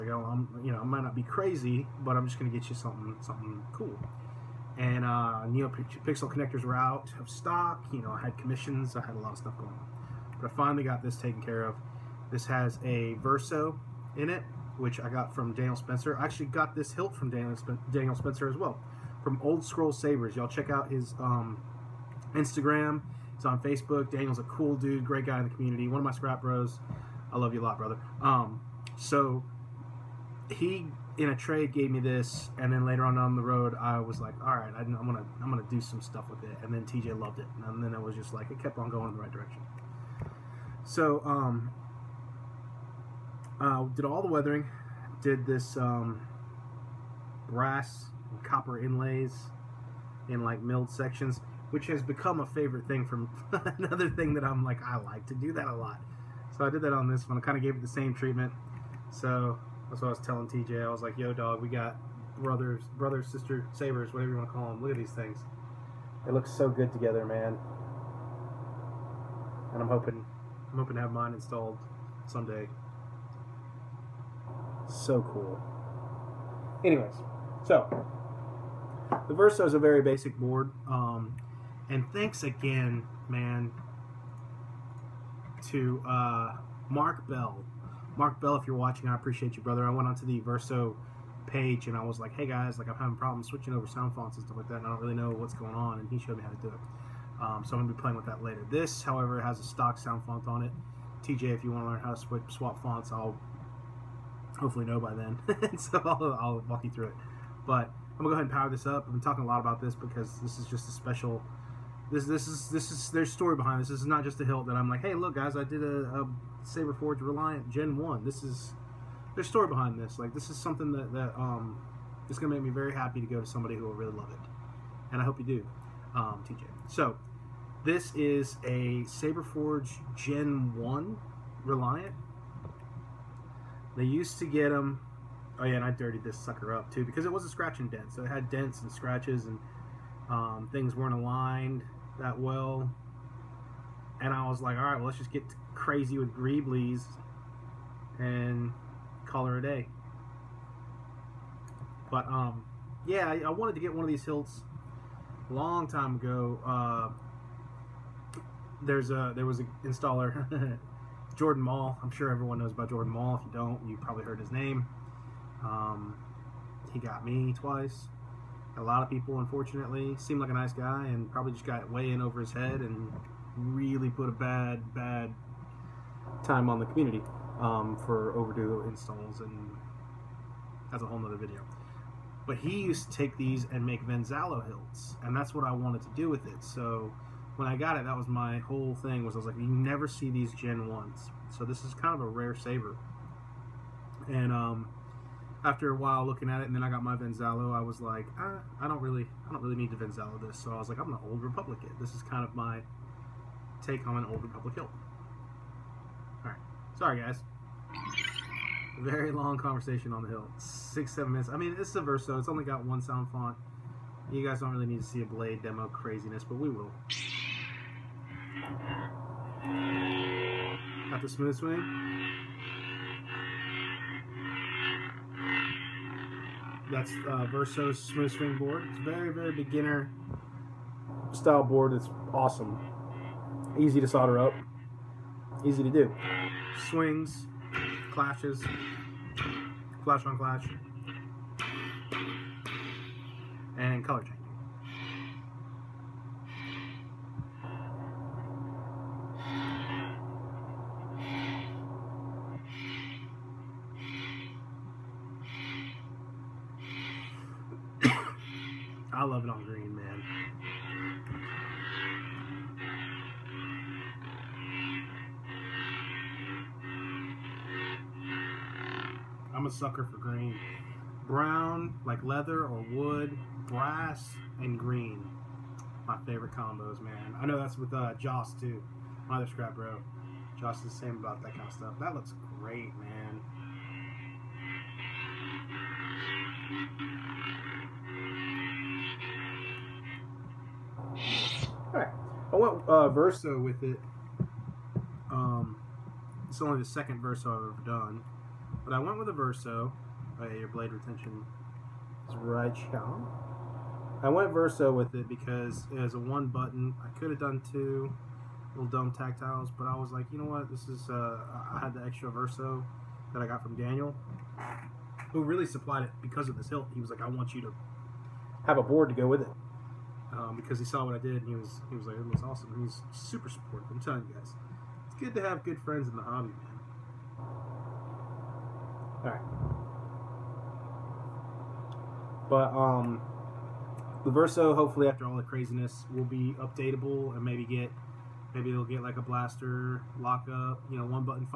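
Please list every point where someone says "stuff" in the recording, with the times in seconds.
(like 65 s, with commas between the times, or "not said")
9 s, 36 s, 94 s, 281 s.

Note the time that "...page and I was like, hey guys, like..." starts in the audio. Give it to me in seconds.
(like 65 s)
91 s.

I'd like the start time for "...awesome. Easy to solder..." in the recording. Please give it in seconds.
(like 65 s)
232 s.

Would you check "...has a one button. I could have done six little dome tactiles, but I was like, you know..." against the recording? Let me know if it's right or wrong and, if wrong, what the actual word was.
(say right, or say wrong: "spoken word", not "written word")
wrong: "two", not "six".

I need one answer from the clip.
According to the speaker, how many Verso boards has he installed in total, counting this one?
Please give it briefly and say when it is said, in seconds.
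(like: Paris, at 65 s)
2, at 296 s.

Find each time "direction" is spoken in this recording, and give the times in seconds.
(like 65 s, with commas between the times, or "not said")
39 s.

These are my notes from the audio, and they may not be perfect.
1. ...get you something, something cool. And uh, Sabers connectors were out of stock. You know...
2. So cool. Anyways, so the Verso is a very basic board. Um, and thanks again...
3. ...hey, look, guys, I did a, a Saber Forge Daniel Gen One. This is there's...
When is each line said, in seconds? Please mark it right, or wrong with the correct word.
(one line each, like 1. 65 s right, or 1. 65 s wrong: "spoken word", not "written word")
1. 2 s wrong: "NeoPixel", not "Sabers"
2. 74 s right
3. 115 s wrong: "Reliant", not "Daniel".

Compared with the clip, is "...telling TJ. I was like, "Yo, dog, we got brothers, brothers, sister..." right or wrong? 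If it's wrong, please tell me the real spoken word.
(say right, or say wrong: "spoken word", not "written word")
right.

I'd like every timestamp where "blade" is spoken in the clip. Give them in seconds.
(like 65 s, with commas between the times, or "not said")
215 s, 300 s.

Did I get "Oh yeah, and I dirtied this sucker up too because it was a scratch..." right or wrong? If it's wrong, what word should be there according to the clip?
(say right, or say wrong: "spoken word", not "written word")
right.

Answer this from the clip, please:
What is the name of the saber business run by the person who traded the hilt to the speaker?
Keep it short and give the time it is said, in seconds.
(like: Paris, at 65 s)
Old Scroll Sabers, at 19 s.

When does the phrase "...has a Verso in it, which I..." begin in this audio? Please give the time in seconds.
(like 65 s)
12 s.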